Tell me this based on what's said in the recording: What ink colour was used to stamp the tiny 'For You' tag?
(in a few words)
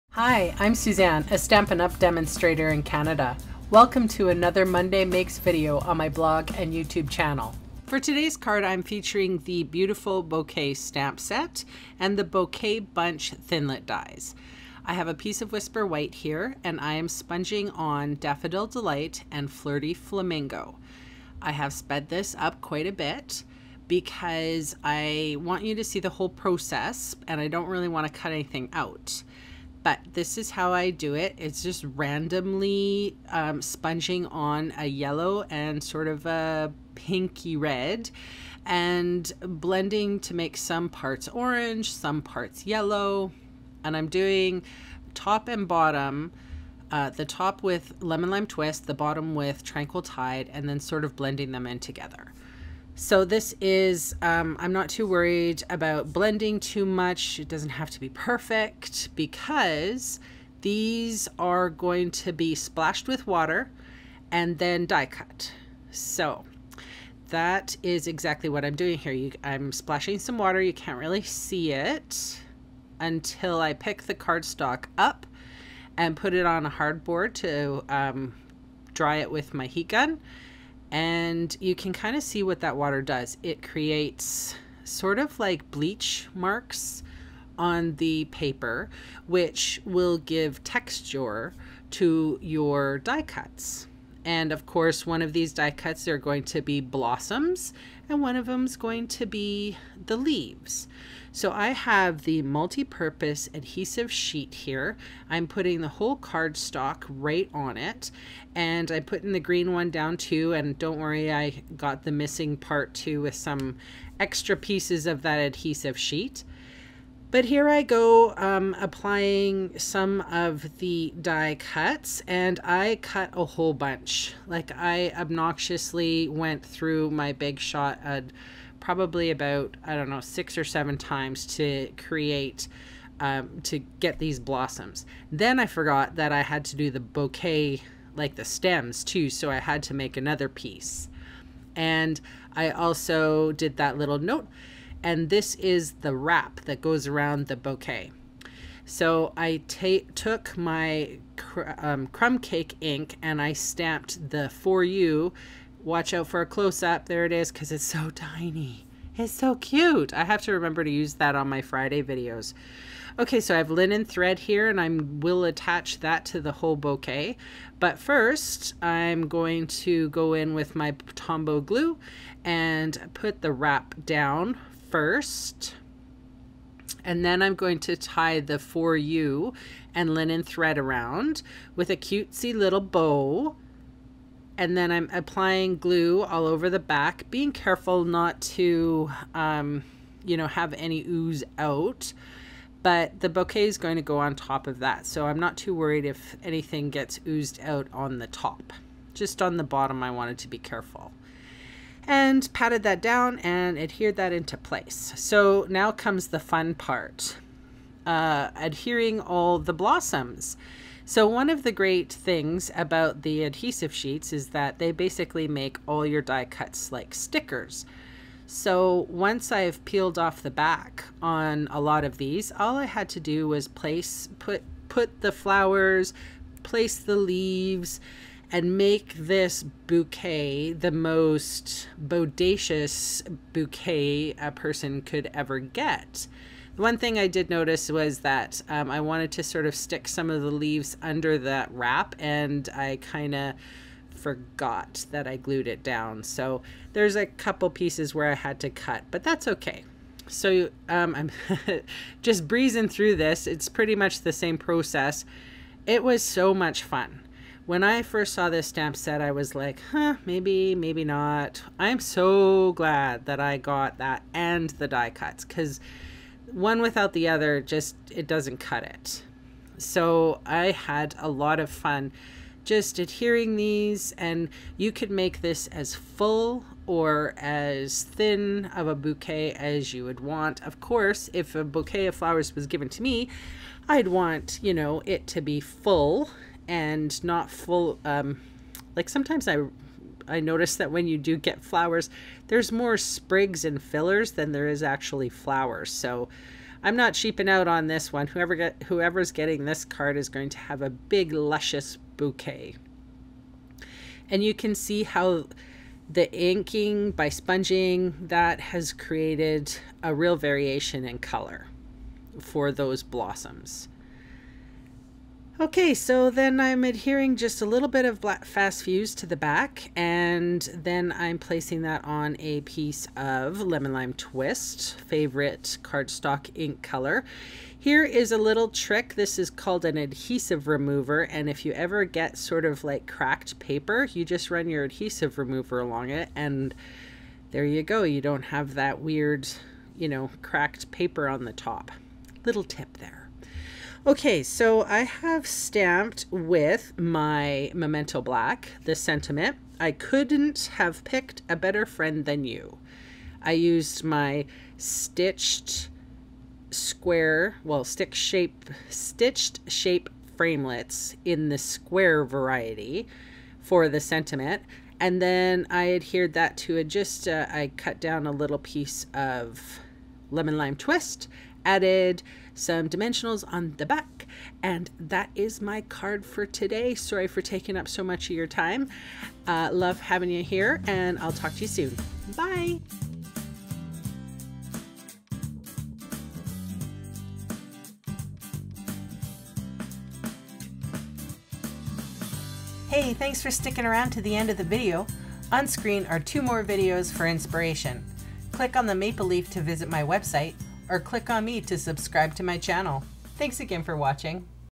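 Crumb Cake.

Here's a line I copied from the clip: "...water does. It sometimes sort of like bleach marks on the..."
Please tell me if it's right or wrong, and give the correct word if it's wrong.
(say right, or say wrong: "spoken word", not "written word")
wrong: "creates", not "sometimes".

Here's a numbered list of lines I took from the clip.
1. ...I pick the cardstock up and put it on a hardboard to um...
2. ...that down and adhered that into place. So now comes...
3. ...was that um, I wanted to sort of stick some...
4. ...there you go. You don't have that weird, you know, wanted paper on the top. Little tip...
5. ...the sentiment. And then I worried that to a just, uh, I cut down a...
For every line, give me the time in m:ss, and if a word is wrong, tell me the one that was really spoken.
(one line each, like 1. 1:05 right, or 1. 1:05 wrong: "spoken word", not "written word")
1. 1:13 right
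2. 3:22 right
3. 3:57 right
4. 5:37 wrong: "cracked", not "wanted"
5. 6:03 wrong: "adhered", not "worried".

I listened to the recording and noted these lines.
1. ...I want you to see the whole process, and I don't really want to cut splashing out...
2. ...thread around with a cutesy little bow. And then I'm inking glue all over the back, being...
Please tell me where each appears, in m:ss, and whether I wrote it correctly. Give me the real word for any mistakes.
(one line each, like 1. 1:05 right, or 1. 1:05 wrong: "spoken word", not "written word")
1. 0:24 wrong: "anything", not "splashing"
2. 3:00 wrong: "applying", not "inking".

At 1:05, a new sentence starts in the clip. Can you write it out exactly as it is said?
So that is exactly what I'm doing here.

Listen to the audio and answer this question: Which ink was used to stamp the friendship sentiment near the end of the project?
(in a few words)
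Memento Black.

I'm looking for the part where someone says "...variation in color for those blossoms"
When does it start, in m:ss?
5:10.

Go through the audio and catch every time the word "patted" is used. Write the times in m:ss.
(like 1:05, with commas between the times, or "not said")
3:22.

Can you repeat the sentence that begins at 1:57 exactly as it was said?
But here I go um, applying some of the die cuts and I cut a whole bunch.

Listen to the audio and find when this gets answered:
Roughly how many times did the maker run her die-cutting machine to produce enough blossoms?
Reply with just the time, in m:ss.
2:10.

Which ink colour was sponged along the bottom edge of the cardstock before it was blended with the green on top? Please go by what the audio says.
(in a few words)
Tranquil Tide.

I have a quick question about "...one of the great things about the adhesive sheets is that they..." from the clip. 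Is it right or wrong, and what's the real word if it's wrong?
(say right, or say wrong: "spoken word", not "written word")
right.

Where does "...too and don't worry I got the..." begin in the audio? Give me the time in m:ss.
1:50.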